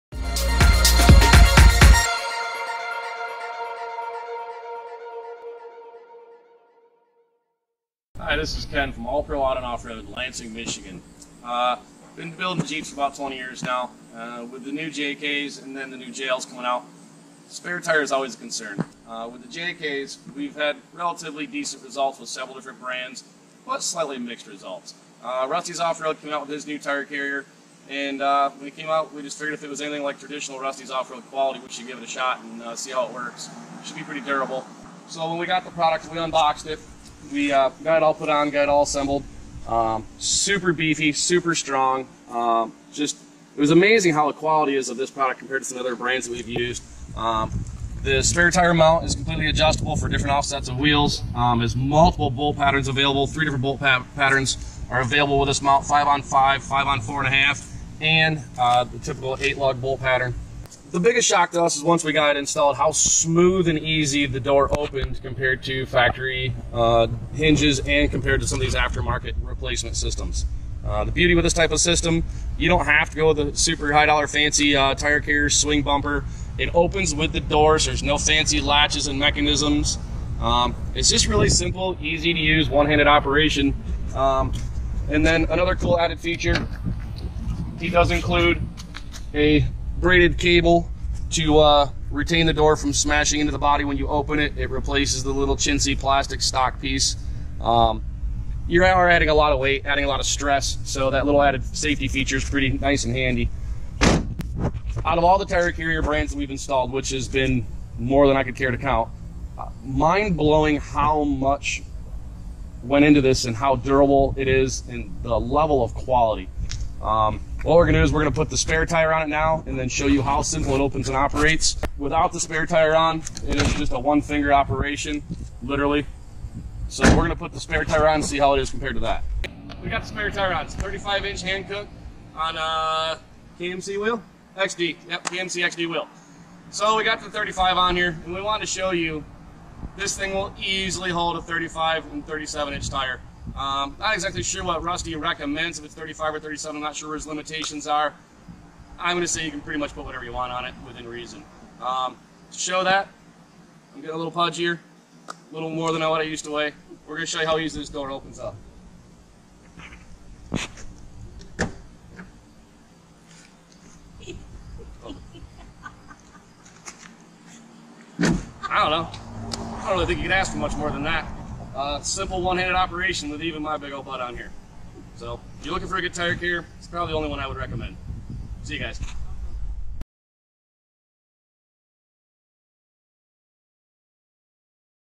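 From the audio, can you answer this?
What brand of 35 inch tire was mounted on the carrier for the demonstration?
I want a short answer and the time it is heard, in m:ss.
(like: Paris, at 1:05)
Hankook, at 2:11.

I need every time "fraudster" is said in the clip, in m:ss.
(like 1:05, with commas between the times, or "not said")
not said.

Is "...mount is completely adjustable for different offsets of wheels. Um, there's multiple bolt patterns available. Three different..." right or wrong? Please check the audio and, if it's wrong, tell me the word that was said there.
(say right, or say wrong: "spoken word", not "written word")
right.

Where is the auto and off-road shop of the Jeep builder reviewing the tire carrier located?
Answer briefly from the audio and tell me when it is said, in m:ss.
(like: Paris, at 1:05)
Lansing, Michigan, at 0:10.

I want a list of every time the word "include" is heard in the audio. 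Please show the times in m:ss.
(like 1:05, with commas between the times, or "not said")
1:28.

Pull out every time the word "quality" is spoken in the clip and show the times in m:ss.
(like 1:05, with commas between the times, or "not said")
0:31, 0:44, 1:55.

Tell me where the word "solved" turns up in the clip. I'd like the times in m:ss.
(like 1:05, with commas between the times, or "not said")
not said.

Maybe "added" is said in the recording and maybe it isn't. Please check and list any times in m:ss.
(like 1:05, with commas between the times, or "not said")
1:25, 1:41.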